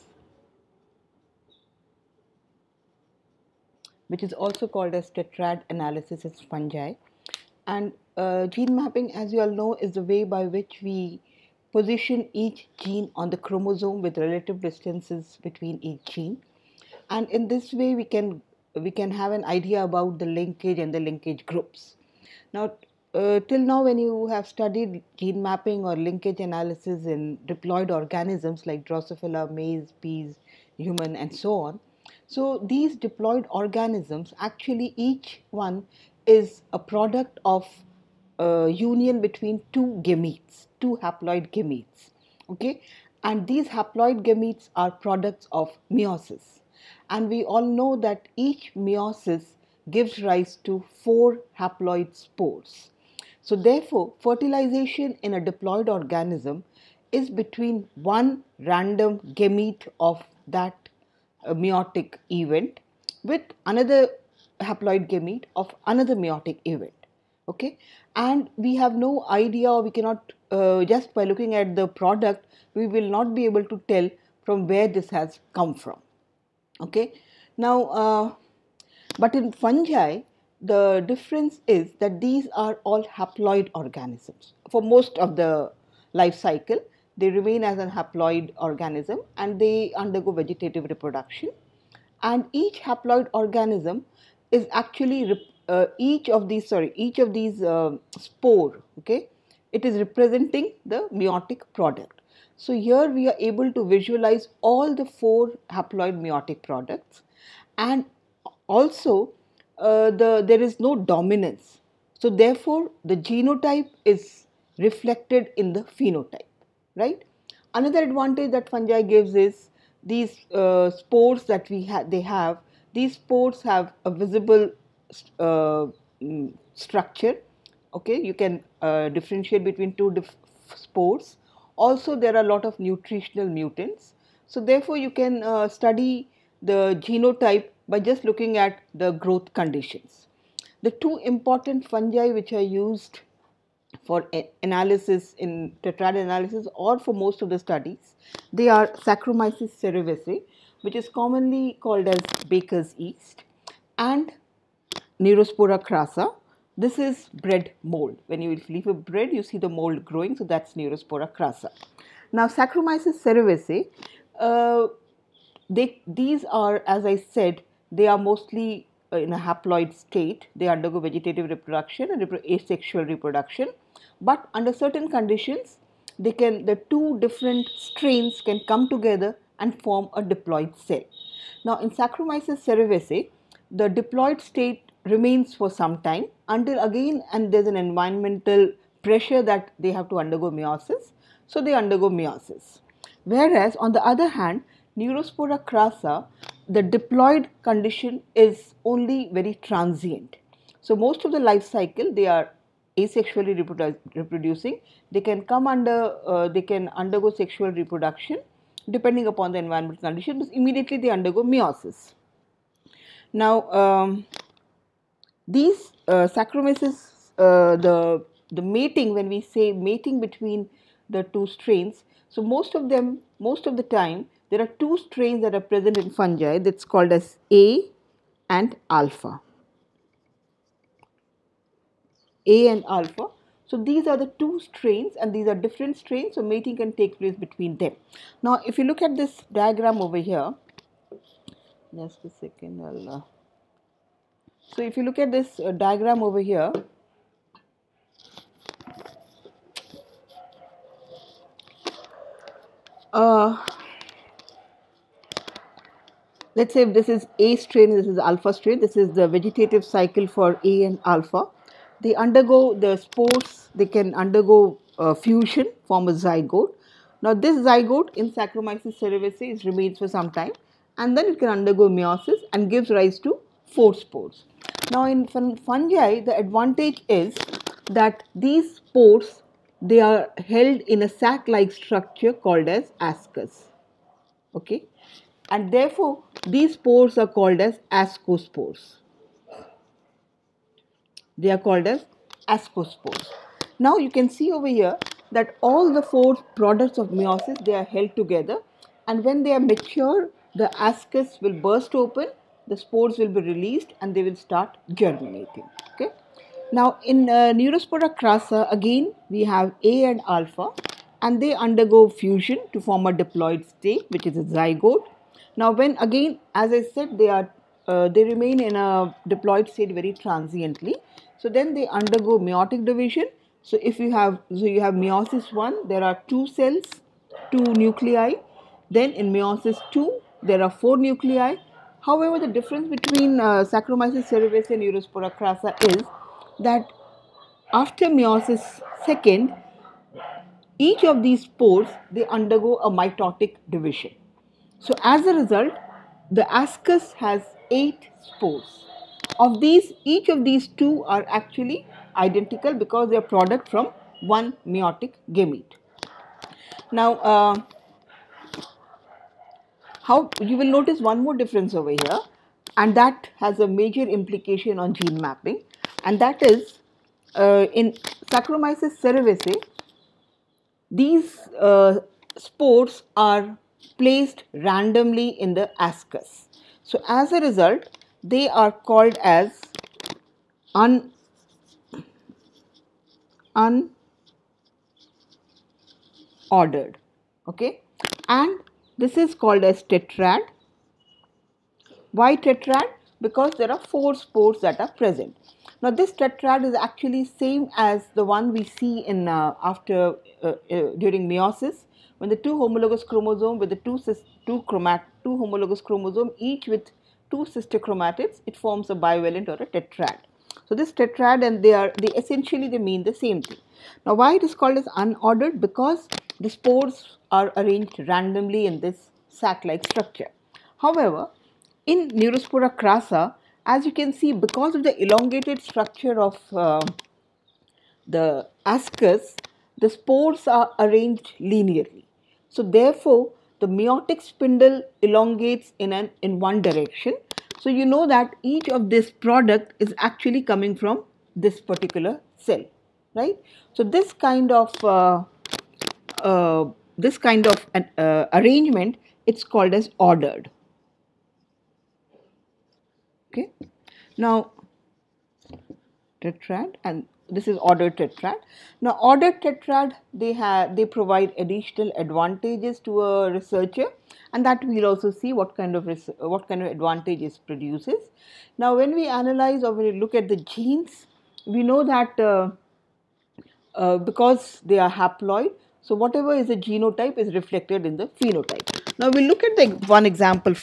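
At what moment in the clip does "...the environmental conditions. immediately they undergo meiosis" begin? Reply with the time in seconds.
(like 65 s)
209 s.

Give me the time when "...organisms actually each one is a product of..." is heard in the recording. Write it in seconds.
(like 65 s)
33 s.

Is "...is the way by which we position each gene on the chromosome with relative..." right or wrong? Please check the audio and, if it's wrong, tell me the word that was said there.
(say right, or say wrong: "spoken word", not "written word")
right.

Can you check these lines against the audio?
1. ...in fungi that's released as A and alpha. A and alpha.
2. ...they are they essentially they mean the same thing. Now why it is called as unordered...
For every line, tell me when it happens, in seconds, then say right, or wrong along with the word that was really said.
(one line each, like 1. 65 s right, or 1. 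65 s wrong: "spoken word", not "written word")
1. 225 s wrong: "called", not "released"
2. 411 s right.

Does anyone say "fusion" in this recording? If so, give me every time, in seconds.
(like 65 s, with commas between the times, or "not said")
265 s, 312 s.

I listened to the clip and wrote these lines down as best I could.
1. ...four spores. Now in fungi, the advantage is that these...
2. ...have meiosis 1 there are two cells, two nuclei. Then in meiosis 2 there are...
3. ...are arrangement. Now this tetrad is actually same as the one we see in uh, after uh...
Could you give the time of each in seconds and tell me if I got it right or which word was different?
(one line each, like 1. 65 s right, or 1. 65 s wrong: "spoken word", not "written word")
1. 273 s right
2. 324 s right
3. 394 s wrong: "present", not "arrangement".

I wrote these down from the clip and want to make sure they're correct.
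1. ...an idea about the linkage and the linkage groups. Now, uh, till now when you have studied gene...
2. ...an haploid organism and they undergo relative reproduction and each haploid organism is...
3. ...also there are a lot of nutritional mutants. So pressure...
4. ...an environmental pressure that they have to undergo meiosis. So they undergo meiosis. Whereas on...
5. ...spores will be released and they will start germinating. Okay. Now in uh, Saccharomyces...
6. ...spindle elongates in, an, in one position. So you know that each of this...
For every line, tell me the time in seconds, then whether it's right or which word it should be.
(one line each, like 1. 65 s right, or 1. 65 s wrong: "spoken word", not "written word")
1. 19 s right
2. 87 s wrong: "vegetative", not "relative"
3. 131 s wrong: "therefore", not "pressure"
4. 187 s right
5. 302 s wrong: "Neurospora", not "Saccharomyces"
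6. 434 s wrong: "direction", not "position".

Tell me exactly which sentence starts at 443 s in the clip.
So this kind of uh, uh, this kind of an uh, arrangement, it's called as ordered.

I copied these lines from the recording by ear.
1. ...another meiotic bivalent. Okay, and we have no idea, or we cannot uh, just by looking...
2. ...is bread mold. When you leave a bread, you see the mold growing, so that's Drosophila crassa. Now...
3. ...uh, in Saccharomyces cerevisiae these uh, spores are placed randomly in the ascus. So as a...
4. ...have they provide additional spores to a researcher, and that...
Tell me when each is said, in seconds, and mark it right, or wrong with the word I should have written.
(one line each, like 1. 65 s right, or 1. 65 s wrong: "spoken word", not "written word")
1. 65 s wrong: "event", not "bivalent"
2. 156 s wrong: "Neurospora", not "Drosophila"
3. 367 s right
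4. 460 s wrong: "advantages", not "spores".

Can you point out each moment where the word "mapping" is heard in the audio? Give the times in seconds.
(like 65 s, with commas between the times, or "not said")
8 s, 25 s, 365 s.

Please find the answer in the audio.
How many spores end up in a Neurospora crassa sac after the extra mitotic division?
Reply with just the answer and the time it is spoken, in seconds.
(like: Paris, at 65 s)
8, at 347 s.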